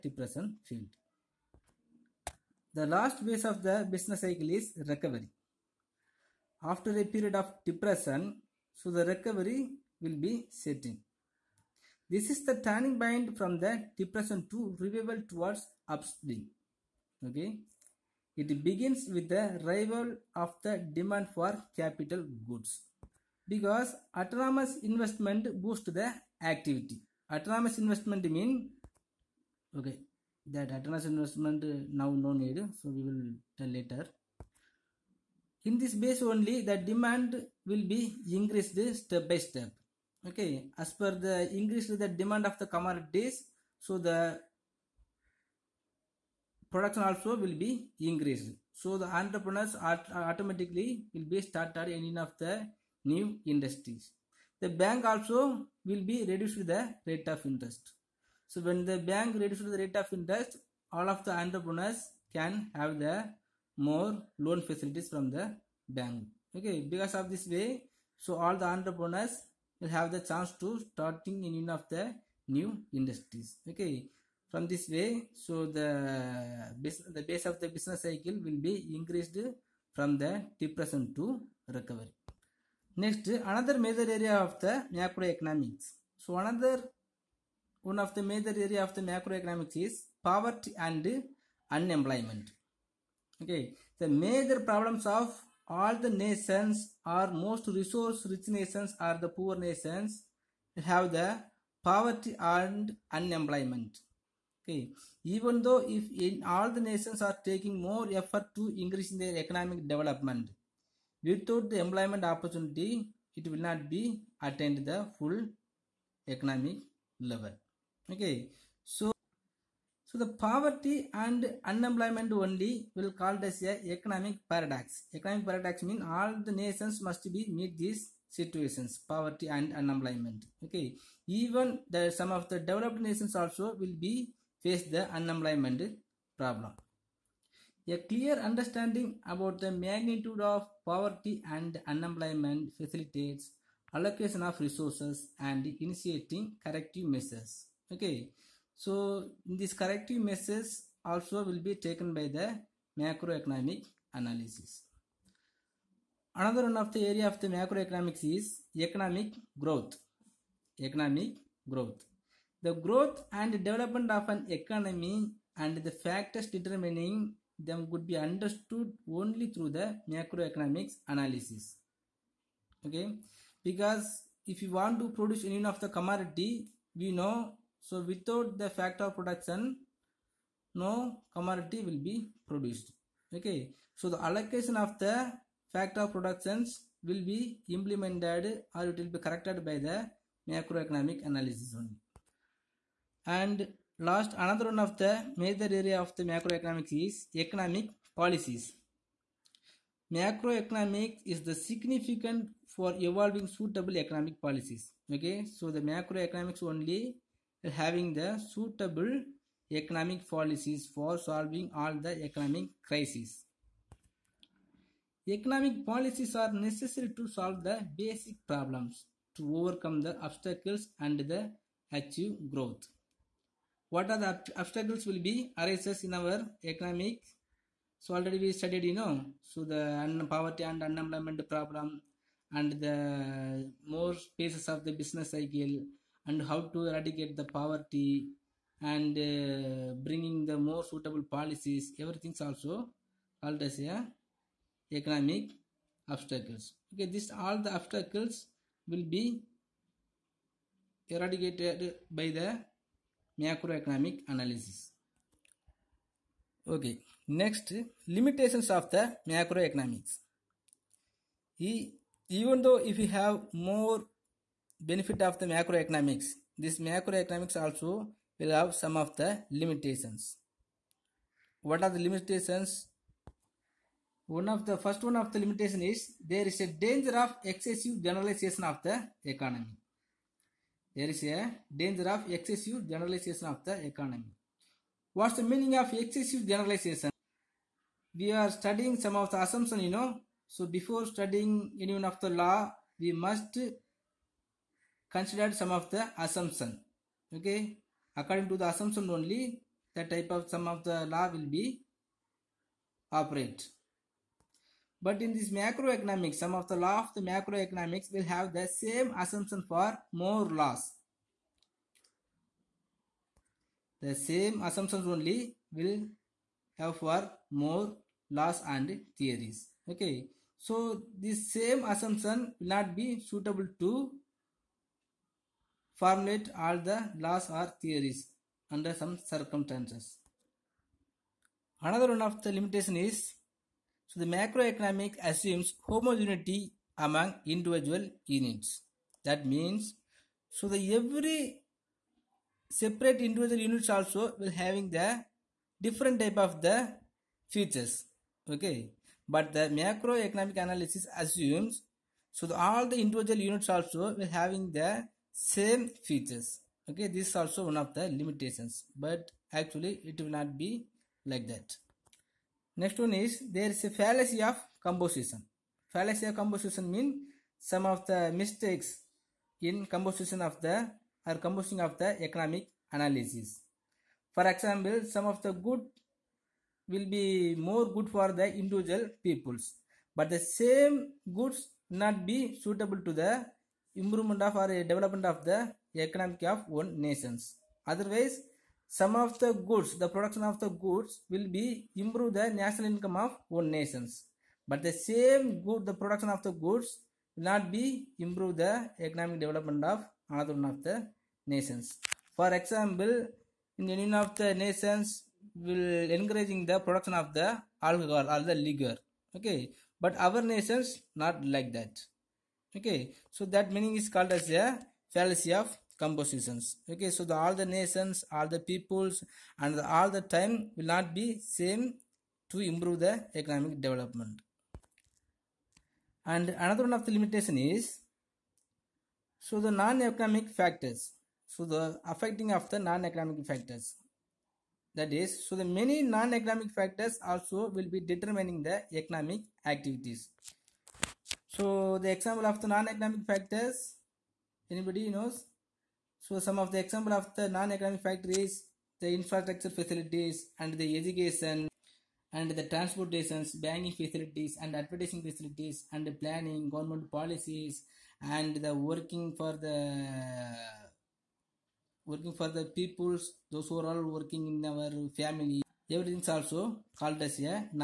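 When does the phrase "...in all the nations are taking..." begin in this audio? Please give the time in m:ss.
1:46.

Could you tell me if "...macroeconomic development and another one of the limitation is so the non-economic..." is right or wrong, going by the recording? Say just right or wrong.
wrong.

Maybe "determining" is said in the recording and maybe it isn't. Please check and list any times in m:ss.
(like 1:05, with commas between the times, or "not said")
2:46, 7:18.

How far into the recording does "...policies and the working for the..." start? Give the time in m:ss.
7:37.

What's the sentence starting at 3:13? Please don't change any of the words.
And last another one of the major area of the macroeconomics is economic policies.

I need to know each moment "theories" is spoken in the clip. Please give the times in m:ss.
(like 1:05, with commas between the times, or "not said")
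5:19, 5:27.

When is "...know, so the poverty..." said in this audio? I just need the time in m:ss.
3:48.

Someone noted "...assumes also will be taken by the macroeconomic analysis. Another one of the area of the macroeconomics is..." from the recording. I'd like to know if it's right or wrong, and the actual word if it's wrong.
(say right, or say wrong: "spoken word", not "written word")
wrong: "measures", not "assumes".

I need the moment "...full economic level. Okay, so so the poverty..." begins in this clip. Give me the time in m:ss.
1:55.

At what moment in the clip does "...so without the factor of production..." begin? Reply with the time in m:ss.
2:57.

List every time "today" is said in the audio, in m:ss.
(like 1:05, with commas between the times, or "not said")
not said.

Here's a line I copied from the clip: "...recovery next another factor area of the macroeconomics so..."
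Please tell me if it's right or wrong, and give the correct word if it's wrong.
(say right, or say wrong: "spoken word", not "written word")
wrong: "major", not "factor".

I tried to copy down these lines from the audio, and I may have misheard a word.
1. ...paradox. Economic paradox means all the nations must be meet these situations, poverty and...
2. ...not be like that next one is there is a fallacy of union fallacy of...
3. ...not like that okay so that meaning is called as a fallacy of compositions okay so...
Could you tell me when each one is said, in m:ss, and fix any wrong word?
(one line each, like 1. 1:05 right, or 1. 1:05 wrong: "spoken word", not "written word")
1. 2:04 right
2. 6:00 wrong: "composition", not "union"
3. 6:51 right.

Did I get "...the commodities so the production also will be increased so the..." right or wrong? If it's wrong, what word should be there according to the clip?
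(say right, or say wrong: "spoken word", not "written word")
right.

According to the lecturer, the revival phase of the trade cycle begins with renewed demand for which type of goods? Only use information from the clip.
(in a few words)
Capital goods.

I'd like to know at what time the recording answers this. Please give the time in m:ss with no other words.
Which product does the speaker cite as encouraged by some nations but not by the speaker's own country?
6:47.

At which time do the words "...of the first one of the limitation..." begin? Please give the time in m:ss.
4:34.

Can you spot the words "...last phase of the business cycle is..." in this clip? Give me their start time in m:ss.
0:02.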